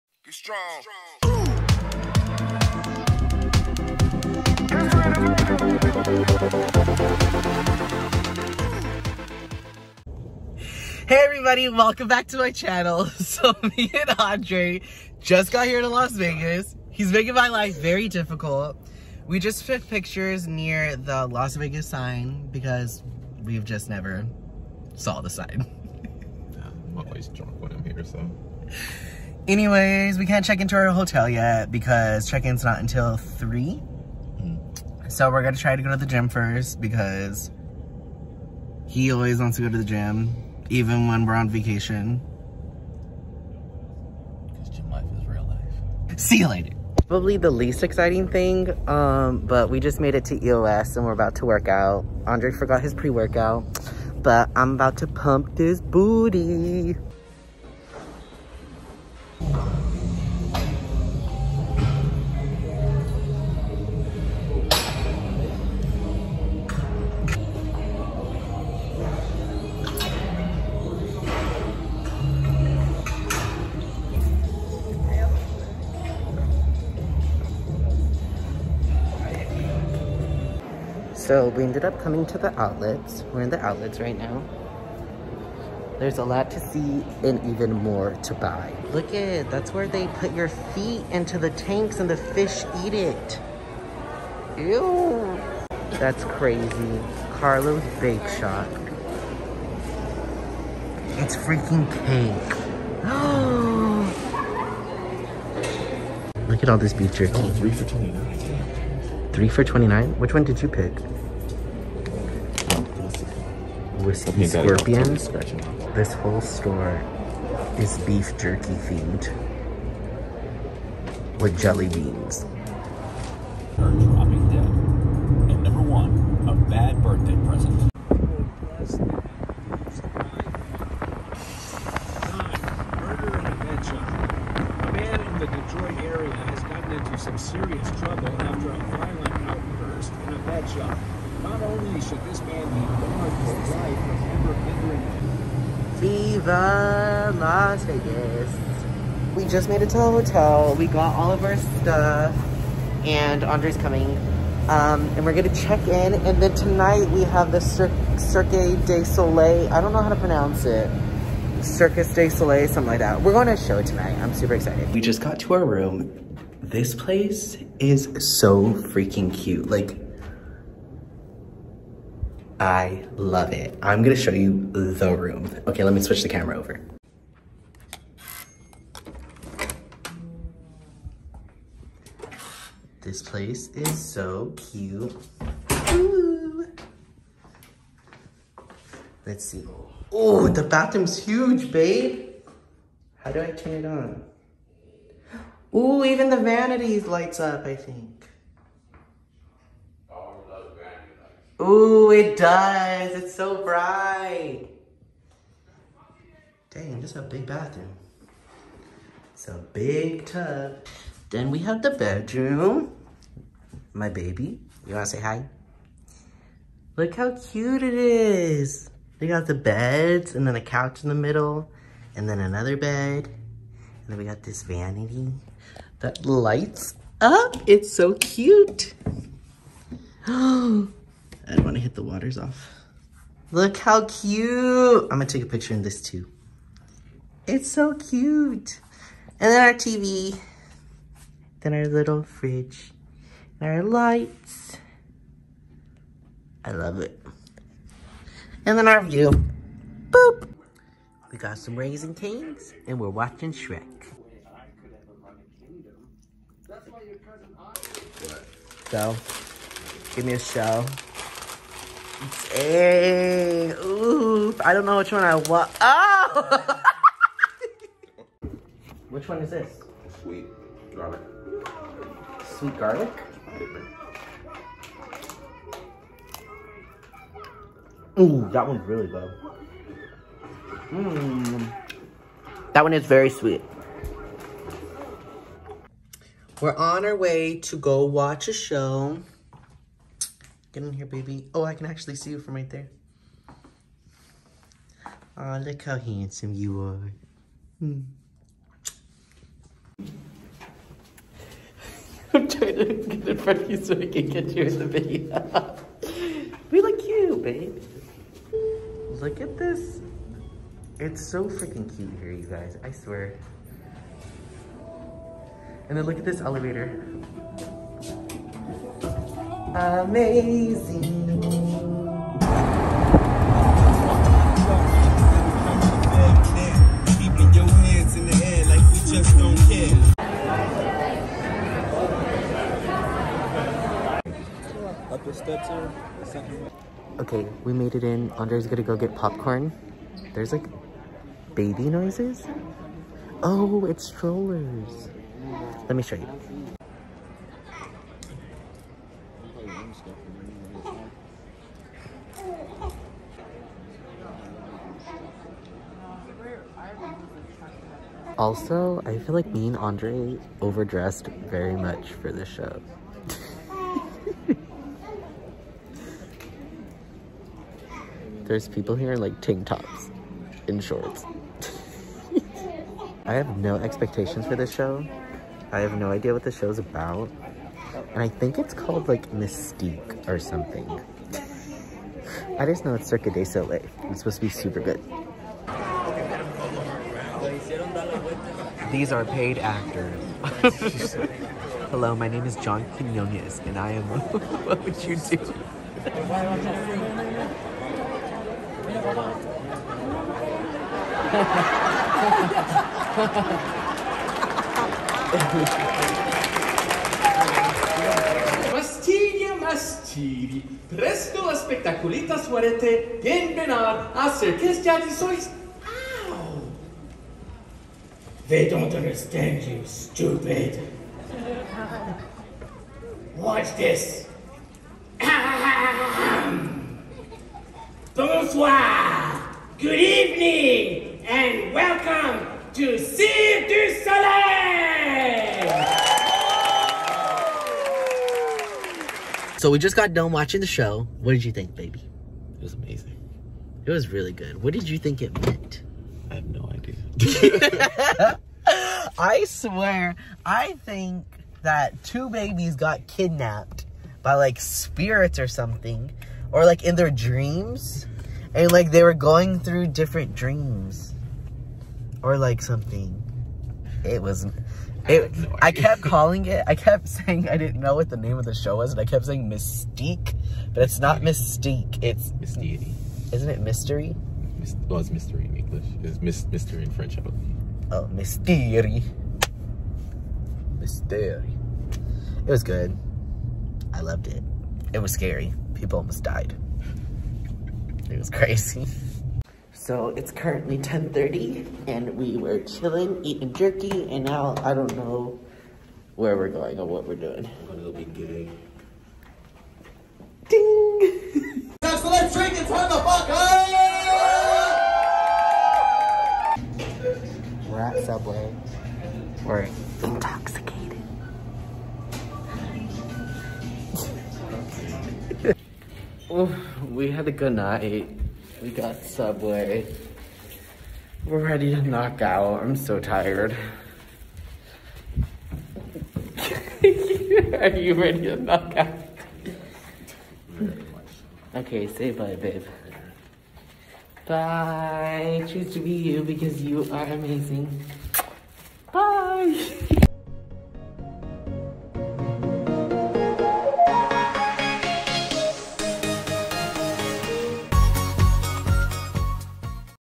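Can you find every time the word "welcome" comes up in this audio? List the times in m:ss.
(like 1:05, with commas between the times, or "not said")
0:11, 7:11.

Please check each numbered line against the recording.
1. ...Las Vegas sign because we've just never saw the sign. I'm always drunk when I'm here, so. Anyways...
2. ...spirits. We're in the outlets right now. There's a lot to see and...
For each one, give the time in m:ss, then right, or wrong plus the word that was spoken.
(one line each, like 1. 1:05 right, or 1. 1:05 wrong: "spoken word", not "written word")
1. 0:21 right
2. 1:22 wrong: "outlets", not "spirits".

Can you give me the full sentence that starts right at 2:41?
Circus de Soleil, something like that.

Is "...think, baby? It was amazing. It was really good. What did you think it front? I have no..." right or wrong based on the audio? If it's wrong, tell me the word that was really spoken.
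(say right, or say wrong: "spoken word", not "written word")
wrong: "meant", not "front".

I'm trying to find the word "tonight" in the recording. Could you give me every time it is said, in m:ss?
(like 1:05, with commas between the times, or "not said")
2:36, 2:43.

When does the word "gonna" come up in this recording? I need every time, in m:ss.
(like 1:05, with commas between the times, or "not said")
0:35, 2:35, 2:54, 5:38, 8:17.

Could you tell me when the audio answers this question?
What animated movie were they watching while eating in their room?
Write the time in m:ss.
4:13.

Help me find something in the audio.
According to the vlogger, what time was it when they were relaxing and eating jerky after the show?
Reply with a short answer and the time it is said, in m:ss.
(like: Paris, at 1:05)
10:30, at 8:10.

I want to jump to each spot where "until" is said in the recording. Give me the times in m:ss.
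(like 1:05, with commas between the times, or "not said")
0:32.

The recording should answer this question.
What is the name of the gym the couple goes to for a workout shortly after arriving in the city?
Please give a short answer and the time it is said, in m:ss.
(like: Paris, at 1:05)
EOS, at 0:50.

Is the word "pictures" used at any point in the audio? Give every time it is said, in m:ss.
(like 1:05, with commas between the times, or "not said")
0:19, 3:55.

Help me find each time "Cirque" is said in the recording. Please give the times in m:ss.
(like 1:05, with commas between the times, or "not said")
2:38, 6:23, 7:12.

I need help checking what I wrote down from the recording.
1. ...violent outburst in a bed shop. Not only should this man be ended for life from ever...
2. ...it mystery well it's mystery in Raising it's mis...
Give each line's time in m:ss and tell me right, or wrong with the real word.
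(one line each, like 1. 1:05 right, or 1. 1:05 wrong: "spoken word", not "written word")
1. 2:18 wrong: "barred", not "ended"
2. 7:53 wrong: "English", not "Raising".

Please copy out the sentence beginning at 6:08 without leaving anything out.
There's people here in like tank tops and shorts.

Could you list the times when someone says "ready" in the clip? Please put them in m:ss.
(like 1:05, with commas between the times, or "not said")
8:41, 8:47.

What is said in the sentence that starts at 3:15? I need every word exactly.
Ooh, even the vanities lights up, I think.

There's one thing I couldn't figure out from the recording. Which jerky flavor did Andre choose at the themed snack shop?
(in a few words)
Whiskey Scorpion.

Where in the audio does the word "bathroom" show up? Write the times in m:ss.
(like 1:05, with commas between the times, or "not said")
3:10, 3:27.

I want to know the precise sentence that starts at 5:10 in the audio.
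It's so freaking cute here, you guys.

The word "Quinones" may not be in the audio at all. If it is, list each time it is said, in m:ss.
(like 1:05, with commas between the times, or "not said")
6:32.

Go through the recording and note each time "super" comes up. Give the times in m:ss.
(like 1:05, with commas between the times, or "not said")
2:44, 6:24.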